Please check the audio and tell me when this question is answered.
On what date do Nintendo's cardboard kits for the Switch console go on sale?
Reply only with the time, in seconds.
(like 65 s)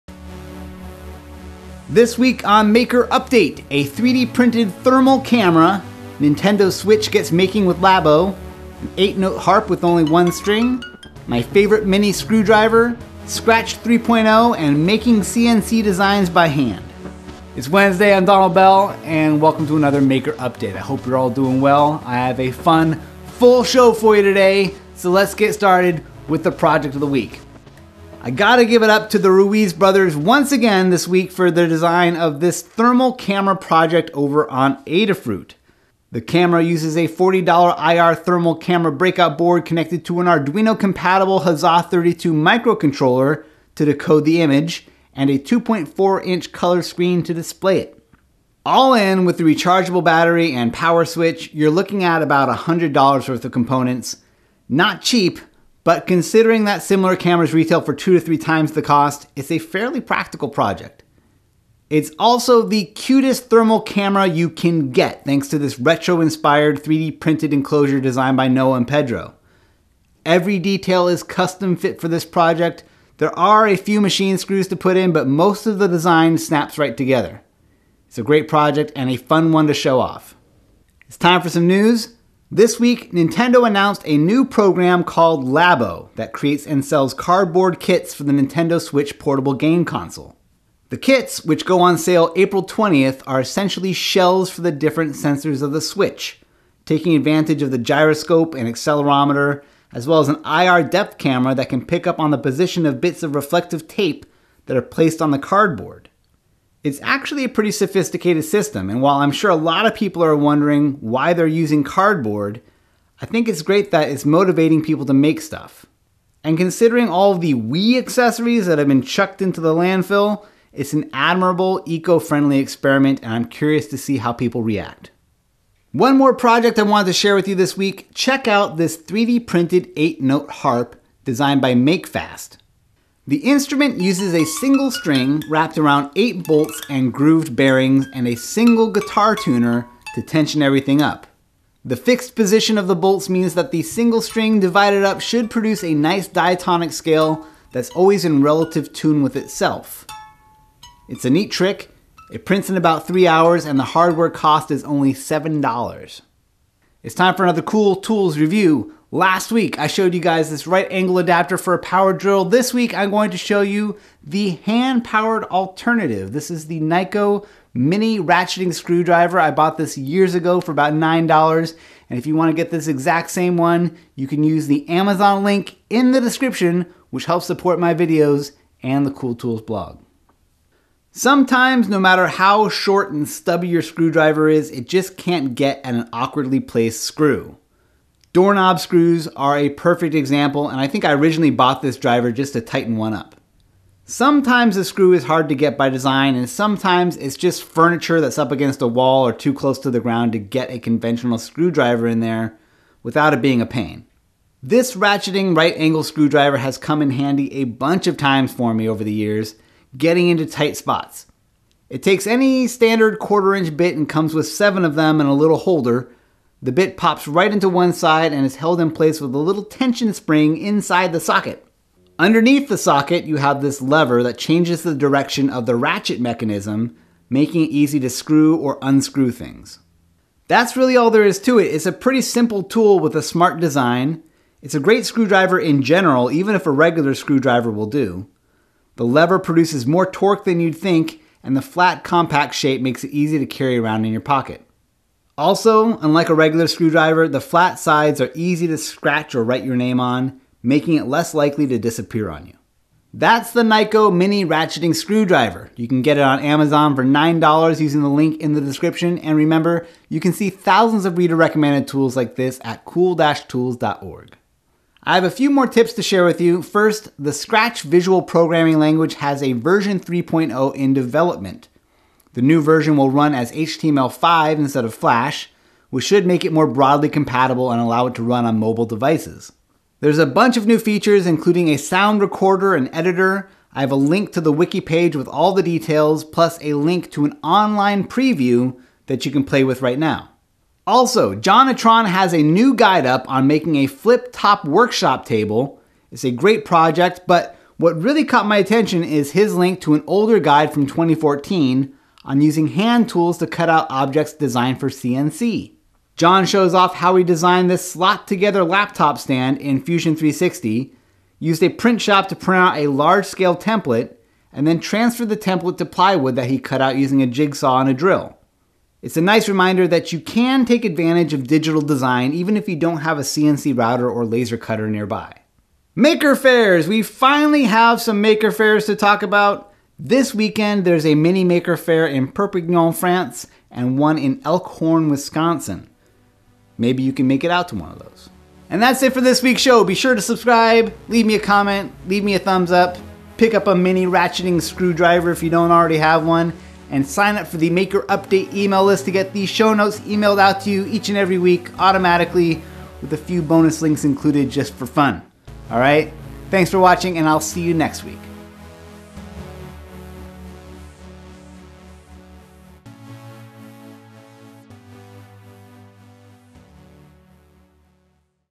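92 s.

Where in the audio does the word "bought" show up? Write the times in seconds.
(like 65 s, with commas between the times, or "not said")
169 s, 191 s.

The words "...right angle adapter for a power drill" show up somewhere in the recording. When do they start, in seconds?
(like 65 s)
160 s.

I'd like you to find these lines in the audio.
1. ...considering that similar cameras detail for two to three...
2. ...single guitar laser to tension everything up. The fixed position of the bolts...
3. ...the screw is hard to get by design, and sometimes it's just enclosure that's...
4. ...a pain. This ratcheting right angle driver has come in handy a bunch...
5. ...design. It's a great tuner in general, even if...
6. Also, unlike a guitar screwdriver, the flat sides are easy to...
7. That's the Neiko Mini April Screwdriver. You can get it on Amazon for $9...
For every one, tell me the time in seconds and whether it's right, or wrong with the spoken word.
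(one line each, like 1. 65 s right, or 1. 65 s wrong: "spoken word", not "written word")
1. 56 s wrong: "retail", not "detail"
2. 138 s wrong: "tuner", not "laser"
3. 194 s wrong: "furniture", not "enclosure"
4. 203 s wrong: "screwdriver", not "driver"
5. 233 s wrong: "screwdriver", not "tuner"
6. 245 s wrong: "regular", not "guitar"
7. 253 s wrong: "Ratcheting", not "April".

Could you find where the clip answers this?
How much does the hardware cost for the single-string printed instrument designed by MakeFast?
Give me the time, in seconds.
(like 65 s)
155 s.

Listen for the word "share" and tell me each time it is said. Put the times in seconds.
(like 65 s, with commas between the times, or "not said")
127 s, 266 s.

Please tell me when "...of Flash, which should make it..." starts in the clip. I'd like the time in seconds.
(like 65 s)
274 s.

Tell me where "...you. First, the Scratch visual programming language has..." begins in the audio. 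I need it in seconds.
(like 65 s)
266 s.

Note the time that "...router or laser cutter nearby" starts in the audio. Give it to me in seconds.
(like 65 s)
323 s.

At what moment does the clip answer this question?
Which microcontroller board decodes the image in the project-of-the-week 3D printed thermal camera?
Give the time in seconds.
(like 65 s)
41 s.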